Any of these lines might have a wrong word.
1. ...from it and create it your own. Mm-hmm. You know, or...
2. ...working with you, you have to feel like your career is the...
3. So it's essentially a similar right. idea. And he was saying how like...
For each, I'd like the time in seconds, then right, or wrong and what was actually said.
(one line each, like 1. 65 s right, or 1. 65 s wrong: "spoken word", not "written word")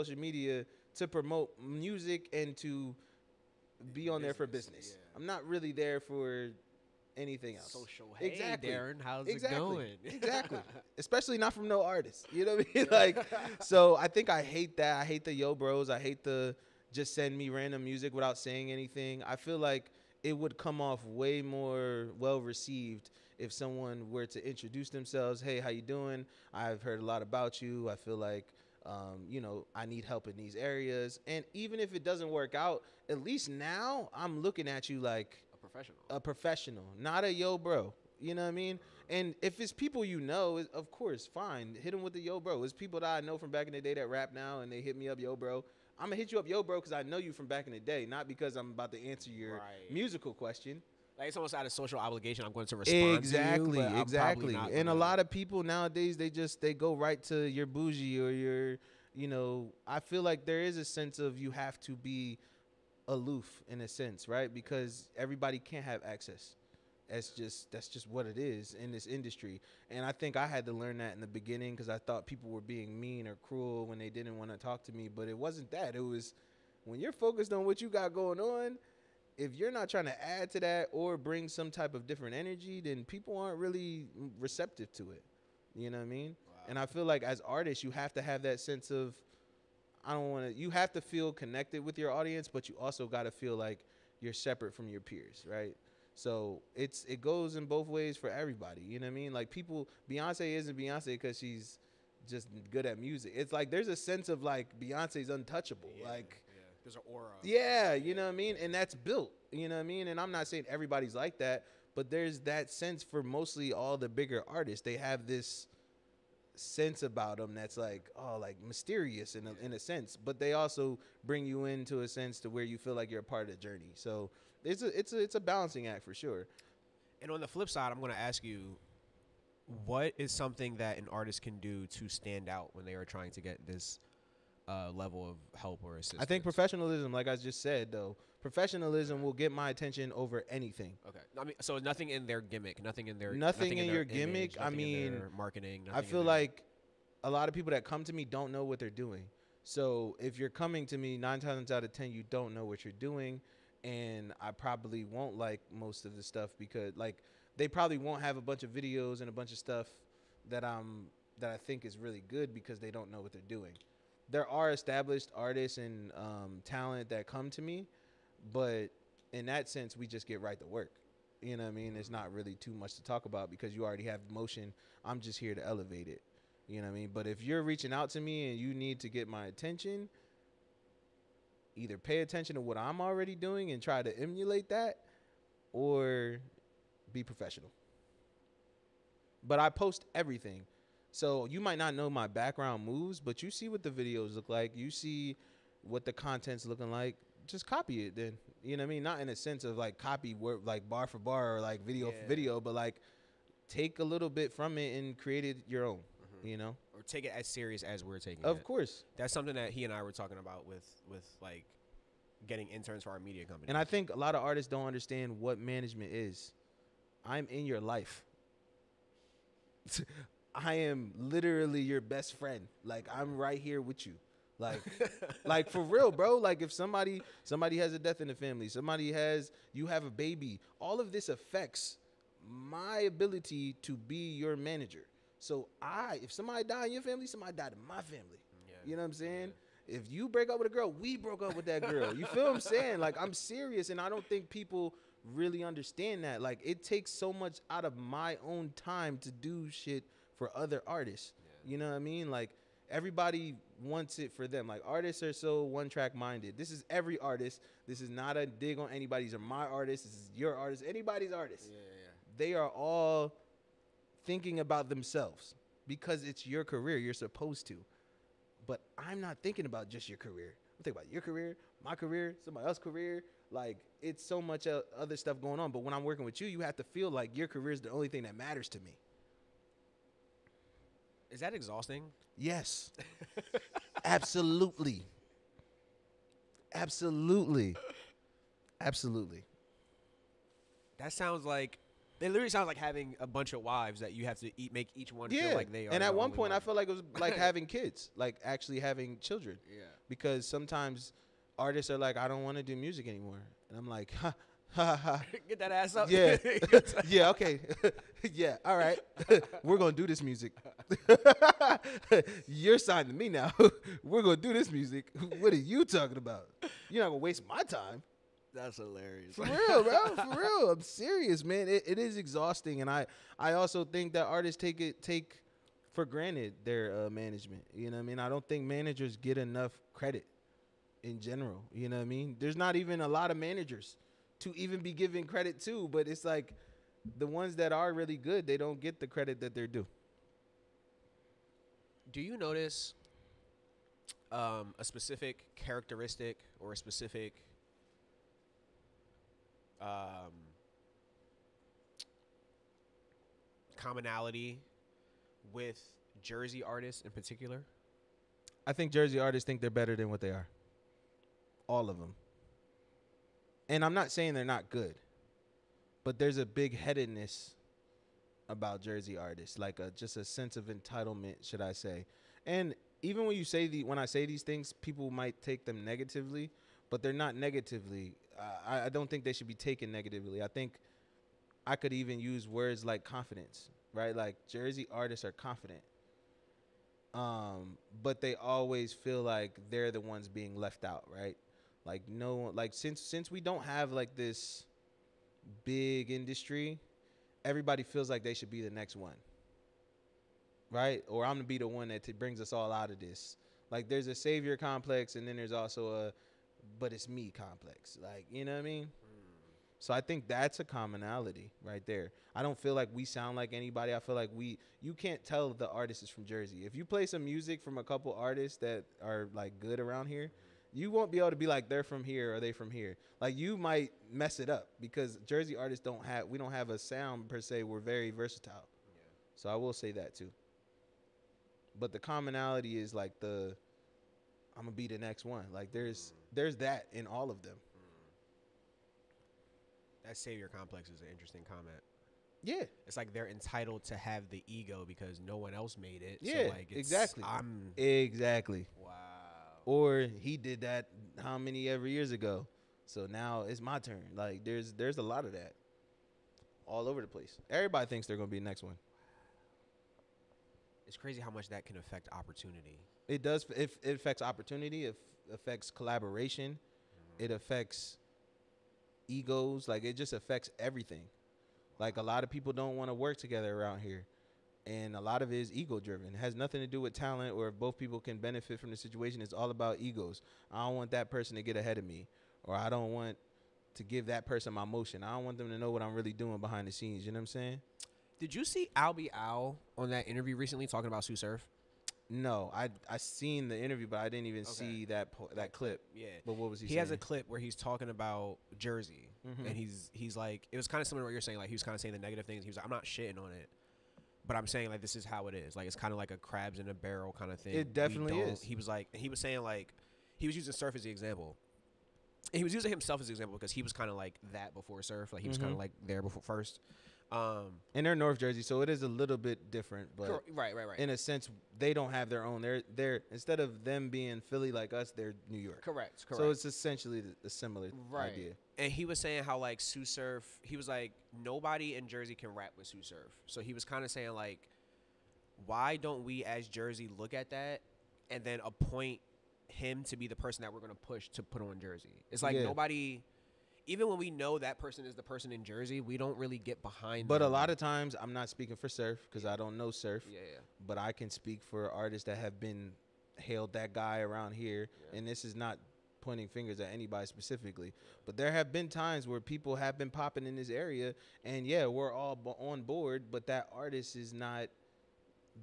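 1. 204 s right
2. 276 s right
3. 526 s right.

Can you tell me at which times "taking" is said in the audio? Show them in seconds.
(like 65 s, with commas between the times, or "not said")
208 s.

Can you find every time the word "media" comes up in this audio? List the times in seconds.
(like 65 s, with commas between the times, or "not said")
0 s, 213 s.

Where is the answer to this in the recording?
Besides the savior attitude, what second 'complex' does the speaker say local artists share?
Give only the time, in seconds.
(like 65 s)
406 s.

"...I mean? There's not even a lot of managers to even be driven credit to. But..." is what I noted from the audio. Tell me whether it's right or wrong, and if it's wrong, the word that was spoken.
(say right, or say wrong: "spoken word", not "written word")
wrong: "given", not "driven".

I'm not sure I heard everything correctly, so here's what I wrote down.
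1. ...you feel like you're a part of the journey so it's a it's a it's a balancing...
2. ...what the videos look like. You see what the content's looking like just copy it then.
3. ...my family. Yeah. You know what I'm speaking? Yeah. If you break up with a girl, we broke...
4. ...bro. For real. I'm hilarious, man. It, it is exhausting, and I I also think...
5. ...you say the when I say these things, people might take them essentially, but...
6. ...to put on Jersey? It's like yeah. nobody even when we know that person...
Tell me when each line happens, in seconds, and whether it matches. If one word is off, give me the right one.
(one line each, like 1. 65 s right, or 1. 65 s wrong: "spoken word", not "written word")
1. 122 s right
2. 193 s right
3. 237 s wrong: "saying", not "speaking"
4. 319 s wrong: "serious", not "hilarious"
5. 373 s wrong: "negatively", not "essentially"
6. 541 s right.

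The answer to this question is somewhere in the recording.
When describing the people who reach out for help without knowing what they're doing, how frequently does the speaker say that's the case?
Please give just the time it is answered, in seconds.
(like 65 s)
151 s.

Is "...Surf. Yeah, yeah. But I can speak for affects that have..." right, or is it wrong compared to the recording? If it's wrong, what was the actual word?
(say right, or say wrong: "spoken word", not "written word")
wrong: "artists", not "affects".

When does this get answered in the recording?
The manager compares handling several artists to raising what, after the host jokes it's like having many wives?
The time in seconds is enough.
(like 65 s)
297 s.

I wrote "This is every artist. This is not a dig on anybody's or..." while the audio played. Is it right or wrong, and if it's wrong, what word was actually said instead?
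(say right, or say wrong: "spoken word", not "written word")
right.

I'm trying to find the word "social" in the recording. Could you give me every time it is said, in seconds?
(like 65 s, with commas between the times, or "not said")
7 s, 51 s.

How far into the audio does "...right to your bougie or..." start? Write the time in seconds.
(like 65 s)
56 s.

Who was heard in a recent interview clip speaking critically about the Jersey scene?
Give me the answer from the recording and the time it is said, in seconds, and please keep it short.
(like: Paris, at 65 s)
Albie Al, at 488 s.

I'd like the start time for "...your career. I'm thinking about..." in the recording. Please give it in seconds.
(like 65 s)
270 s.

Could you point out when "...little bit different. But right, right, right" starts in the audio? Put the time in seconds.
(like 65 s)
518 s.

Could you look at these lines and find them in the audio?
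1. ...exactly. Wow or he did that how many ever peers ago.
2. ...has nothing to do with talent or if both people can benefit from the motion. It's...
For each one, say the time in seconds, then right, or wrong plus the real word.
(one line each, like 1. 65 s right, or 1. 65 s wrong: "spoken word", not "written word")
1. 447 s wrong: "years", not "peers"
2. 476 s wrong: "situation", not "motion".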